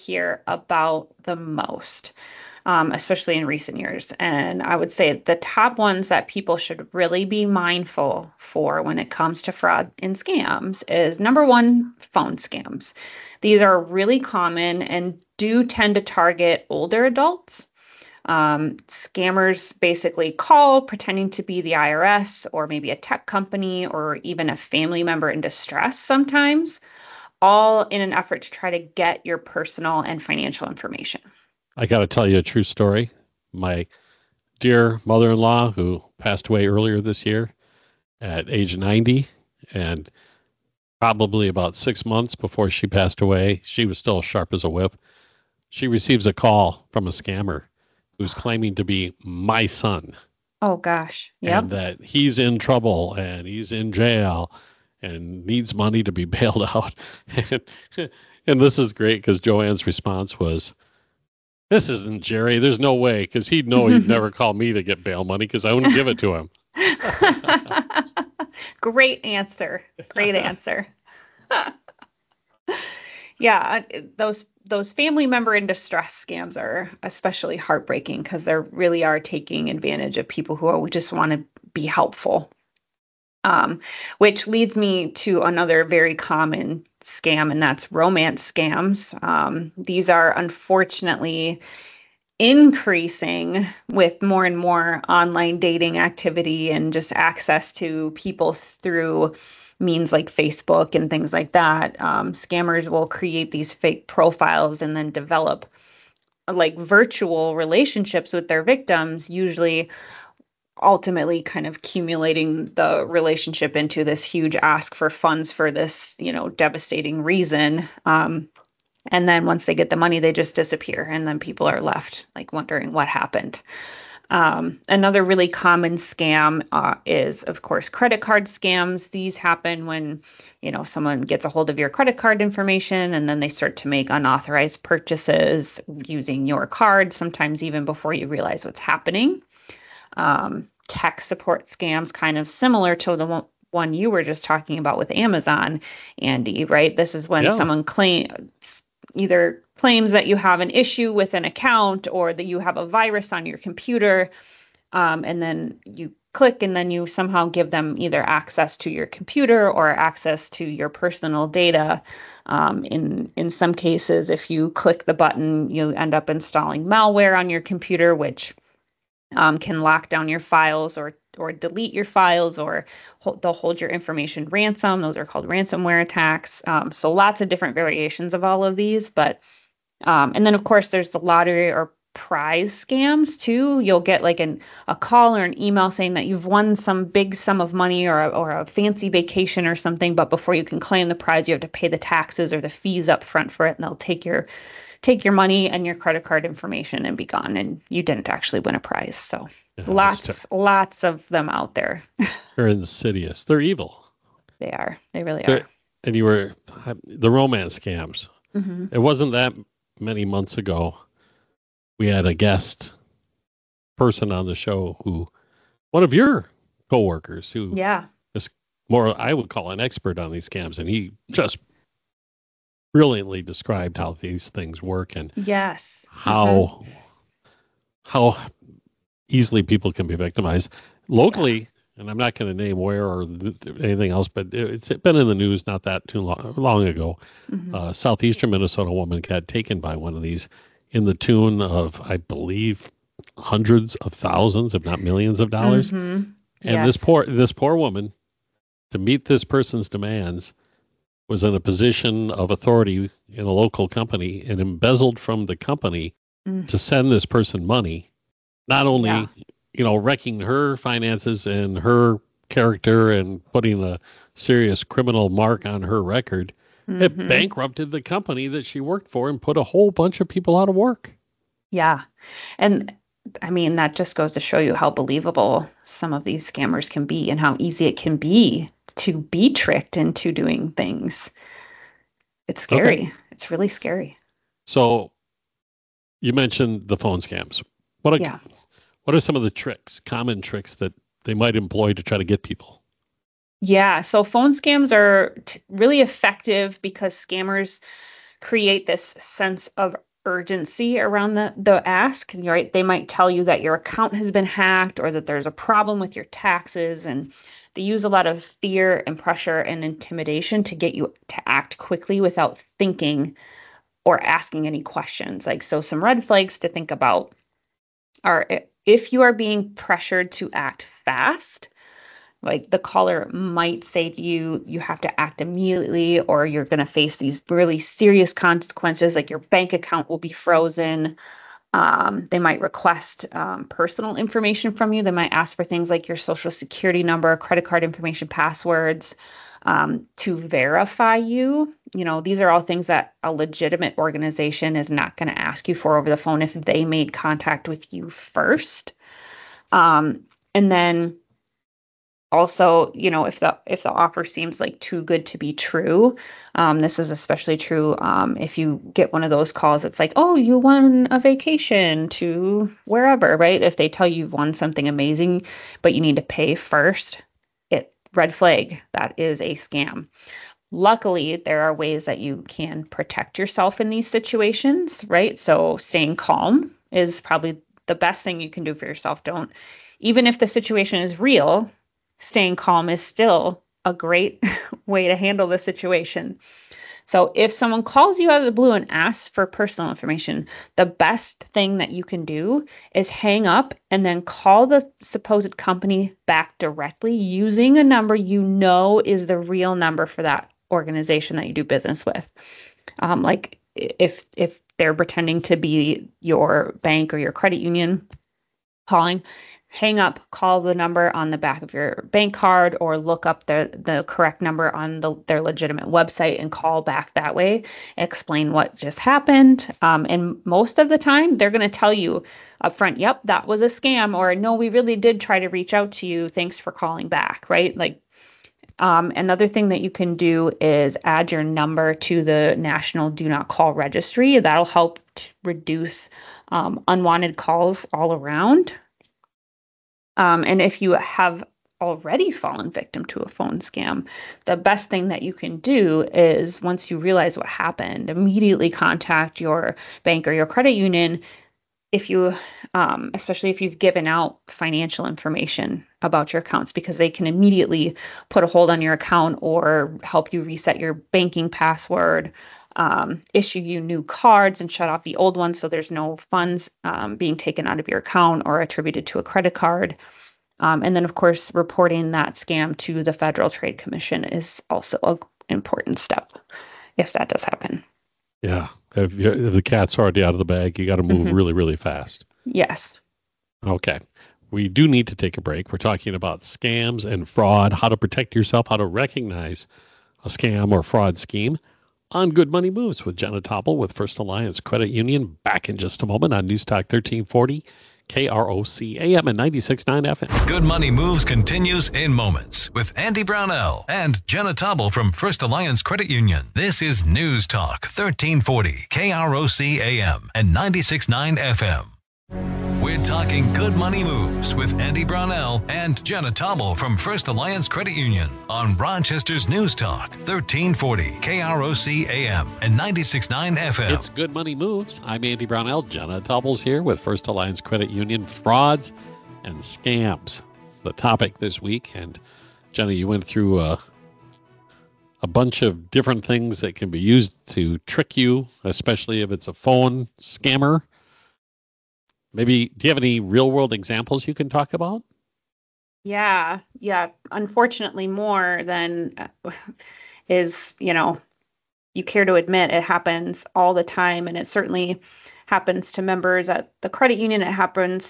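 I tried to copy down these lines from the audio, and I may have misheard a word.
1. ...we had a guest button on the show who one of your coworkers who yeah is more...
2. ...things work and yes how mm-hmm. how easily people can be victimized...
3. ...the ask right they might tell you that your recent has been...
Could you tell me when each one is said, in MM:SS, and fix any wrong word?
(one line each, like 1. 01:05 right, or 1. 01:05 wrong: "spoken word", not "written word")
1. 03:31 wrong: "person", not "button"
2. 03:44 right
3. 05:01 wrong: "account", not "recent".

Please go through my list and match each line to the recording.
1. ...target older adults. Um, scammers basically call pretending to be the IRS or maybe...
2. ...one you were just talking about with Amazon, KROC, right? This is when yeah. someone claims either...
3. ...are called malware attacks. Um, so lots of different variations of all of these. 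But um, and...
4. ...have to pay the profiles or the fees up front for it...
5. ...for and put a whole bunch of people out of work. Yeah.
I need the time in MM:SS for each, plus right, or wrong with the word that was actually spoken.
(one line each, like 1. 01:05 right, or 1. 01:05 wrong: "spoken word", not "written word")
1. 00:16 right
2. 02:23 wrong: "Andy", not "KROC"
3. 02:55 wrong: "ransomware", not "malware"
4. 03:11 wrong: "taxes", not "profiles"
5. 04:29 right.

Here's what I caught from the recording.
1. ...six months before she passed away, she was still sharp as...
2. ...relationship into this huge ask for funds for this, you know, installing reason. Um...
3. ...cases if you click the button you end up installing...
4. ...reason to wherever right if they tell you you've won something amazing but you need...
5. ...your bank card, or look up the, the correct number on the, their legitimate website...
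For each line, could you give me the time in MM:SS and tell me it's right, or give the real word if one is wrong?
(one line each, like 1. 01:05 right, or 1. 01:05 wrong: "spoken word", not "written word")
1. 00:41 right
2. 01:53 wrong: "devastating", not "installing"
3. 02:43 right
4. 06:01 wrong: "vacation", not "reason"
5. 06:51 right.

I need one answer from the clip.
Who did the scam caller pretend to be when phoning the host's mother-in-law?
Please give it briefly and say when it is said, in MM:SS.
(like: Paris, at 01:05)
Jerry, at 01:02.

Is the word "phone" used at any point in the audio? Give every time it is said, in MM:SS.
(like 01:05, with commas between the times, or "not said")
00:11, 04:46, 04:54, 05:46, 07:23, 08:59.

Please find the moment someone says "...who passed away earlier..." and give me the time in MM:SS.
00:35.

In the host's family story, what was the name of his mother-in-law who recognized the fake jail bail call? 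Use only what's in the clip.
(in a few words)
Joanne.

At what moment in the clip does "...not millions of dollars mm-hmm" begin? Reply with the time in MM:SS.
04:04.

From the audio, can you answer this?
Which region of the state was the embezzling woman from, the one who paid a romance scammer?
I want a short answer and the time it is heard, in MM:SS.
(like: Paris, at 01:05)
southeastern Minnesota, at 03:57.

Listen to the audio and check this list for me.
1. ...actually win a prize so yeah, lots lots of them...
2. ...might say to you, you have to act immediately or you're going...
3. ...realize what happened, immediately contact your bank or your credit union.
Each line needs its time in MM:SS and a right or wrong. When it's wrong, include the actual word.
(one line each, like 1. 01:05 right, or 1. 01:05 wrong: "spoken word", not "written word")
1. 03:18 right
2. 05:23 right
3. 07:26 right.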